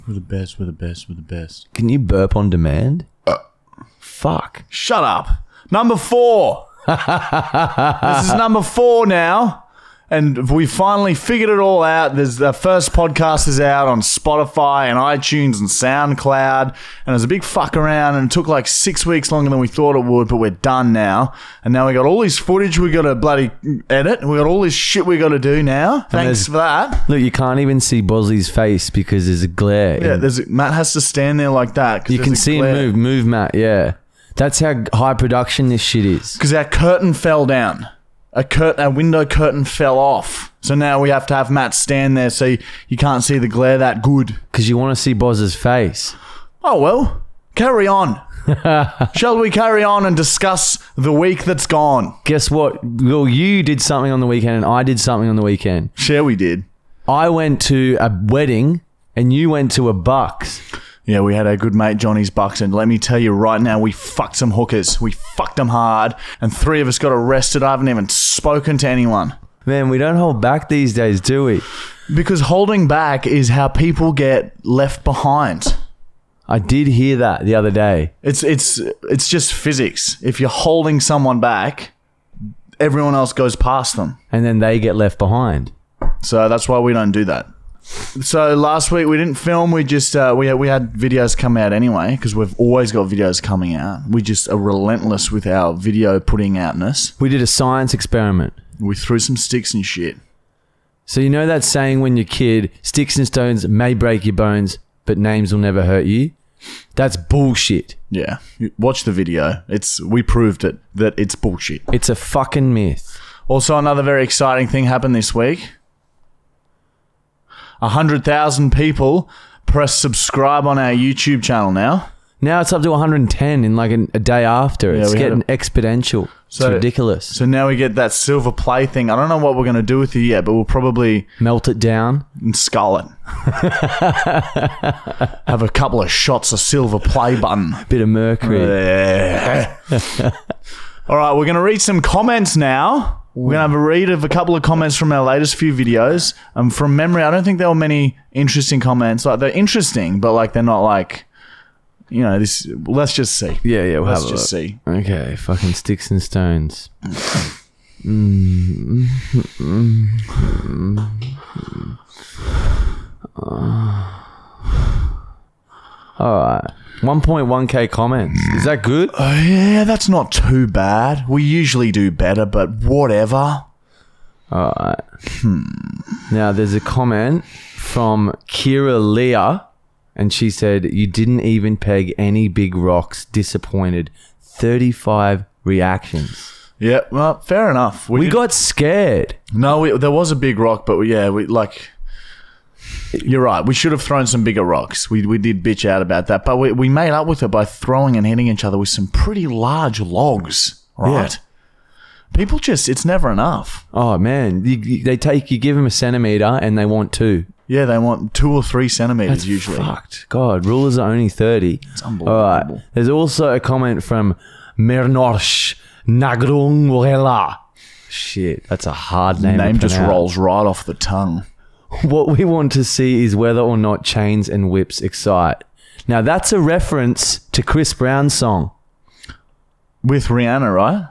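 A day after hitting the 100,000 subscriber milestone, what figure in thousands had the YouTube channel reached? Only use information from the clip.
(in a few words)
110.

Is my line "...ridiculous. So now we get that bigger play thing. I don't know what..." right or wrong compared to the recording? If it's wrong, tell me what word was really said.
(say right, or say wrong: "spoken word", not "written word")
wrong: "silver", not "bigger".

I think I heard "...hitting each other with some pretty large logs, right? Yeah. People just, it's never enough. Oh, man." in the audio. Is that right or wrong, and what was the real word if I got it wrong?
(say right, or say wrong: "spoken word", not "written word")
right.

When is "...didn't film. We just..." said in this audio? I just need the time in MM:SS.
01:29.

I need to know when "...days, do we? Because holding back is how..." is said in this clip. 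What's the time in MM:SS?
01:10.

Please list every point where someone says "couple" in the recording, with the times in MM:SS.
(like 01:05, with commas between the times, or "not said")
02:15, 02:24.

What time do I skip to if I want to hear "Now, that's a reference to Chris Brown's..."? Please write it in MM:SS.
03:46.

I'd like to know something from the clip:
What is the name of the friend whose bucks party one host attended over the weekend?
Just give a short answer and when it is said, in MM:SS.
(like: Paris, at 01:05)
Johnny, at 01:01.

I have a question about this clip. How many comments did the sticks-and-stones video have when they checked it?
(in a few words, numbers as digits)
1.1k.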